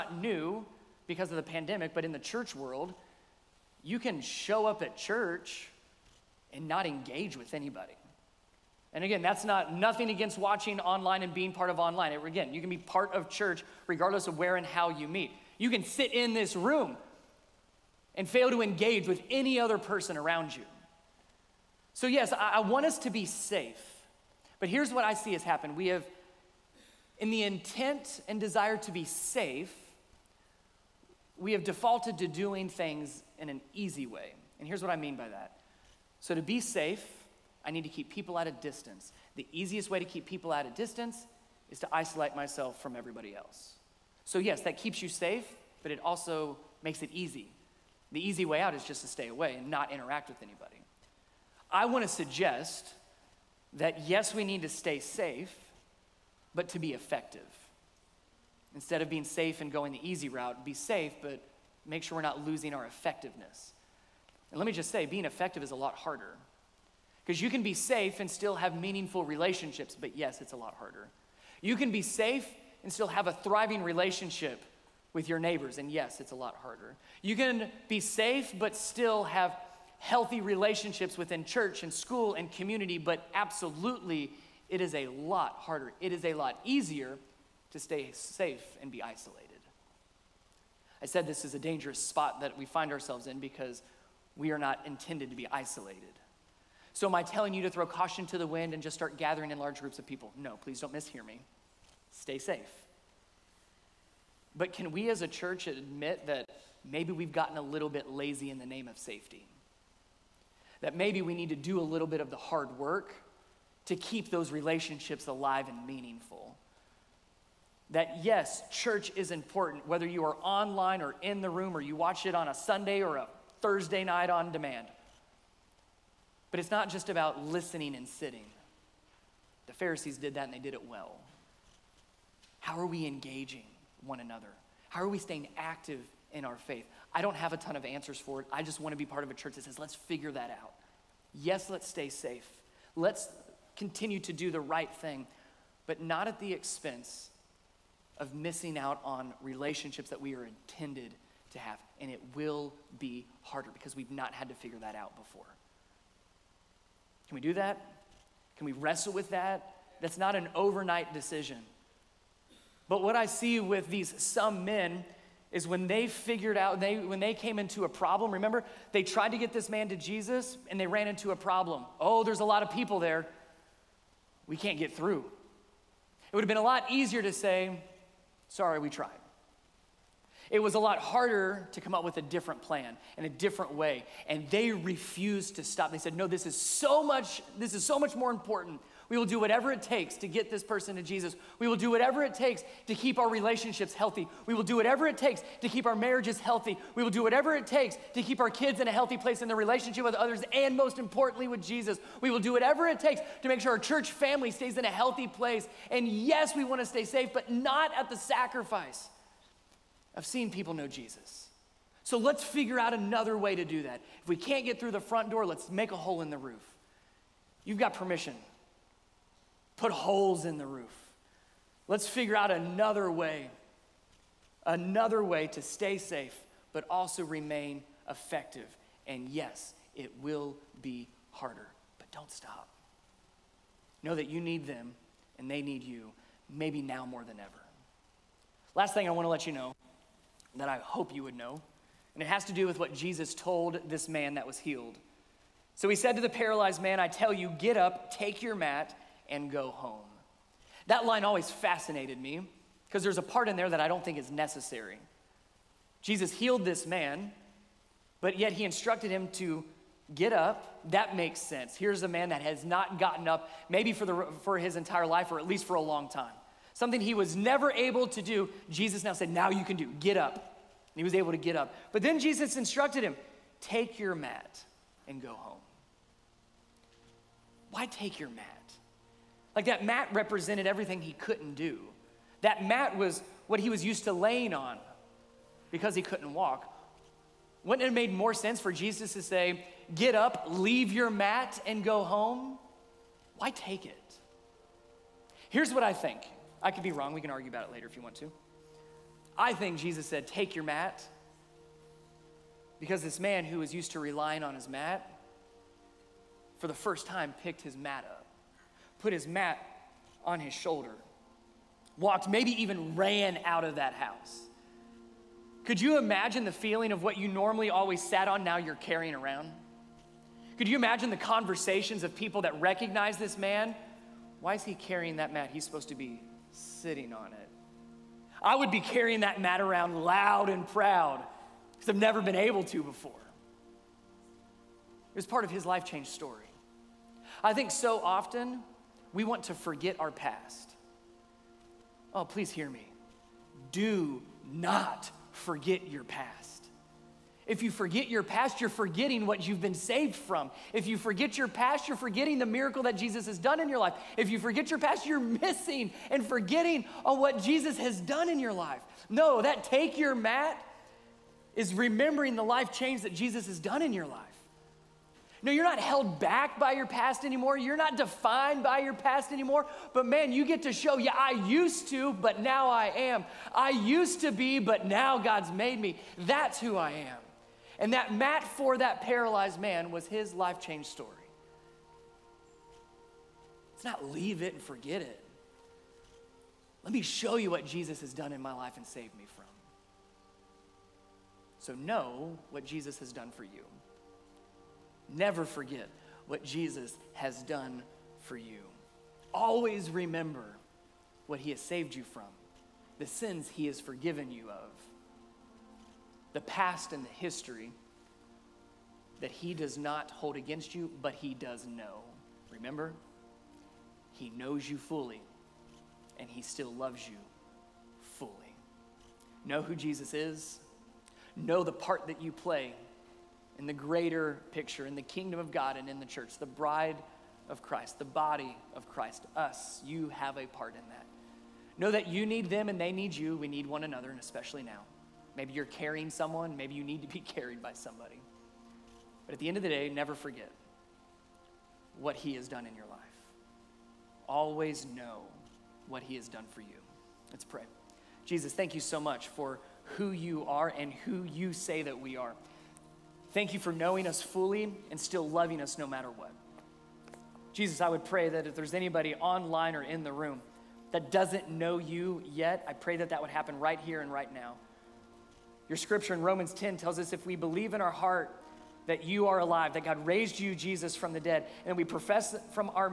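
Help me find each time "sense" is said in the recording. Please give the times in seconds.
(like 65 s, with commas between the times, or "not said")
261 s, 288 s.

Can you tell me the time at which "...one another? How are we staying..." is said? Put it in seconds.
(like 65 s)
134 s.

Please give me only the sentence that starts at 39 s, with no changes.
The easiest way to keep people at a distance is to isolate myself from everybody else.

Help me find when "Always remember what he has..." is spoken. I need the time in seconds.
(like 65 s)
399 s.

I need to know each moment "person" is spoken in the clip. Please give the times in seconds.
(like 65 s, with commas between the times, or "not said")
19 s, 190 s.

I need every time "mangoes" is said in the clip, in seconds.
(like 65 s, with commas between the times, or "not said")
not said.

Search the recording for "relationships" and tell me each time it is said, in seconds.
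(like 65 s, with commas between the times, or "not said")
69 s, 73 s, 80 s, 114 s, 149 s, 193 s, 199 s.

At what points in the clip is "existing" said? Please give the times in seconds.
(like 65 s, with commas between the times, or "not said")
not said.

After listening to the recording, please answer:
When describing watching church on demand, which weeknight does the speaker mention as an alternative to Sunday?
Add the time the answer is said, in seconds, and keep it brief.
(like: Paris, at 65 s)
Thursday, at 123 s.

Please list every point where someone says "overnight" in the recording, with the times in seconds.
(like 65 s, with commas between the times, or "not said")
160 s.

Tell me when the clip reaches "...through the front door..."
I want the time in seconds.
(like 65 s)
214 s.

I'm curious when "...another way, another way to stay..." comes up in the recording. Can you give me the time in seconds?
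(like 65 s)
222 s.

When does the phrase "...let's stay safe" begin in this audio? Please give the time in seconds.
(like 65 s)
141 s.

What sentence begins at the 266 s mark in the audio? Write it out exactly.
Something he was never able to do.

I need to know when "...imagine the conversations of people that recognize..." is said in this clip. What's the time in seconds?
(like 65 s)
320 s.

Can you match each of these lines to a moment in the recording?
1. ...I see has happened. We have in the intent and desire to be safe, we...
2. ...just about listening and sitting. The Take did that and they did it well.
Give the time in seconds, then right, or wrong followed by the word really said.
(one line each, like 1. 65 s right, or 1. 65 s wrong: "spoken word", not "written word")
1. 25 s right
2. 126 s wrong: "Pharisees", not "Take".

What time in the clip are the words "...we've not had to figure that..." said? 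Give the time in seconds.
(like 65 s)
153 s.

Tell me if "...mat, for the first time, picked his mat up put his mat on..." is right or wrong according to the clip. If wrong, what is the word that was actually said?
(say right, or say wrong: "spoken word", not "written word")
right.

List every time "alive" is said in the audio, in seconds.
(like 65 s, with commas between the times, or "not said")
115 s, 469 s.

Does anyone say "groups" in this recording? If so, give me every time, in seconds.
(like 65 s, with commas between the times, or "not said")
99 s.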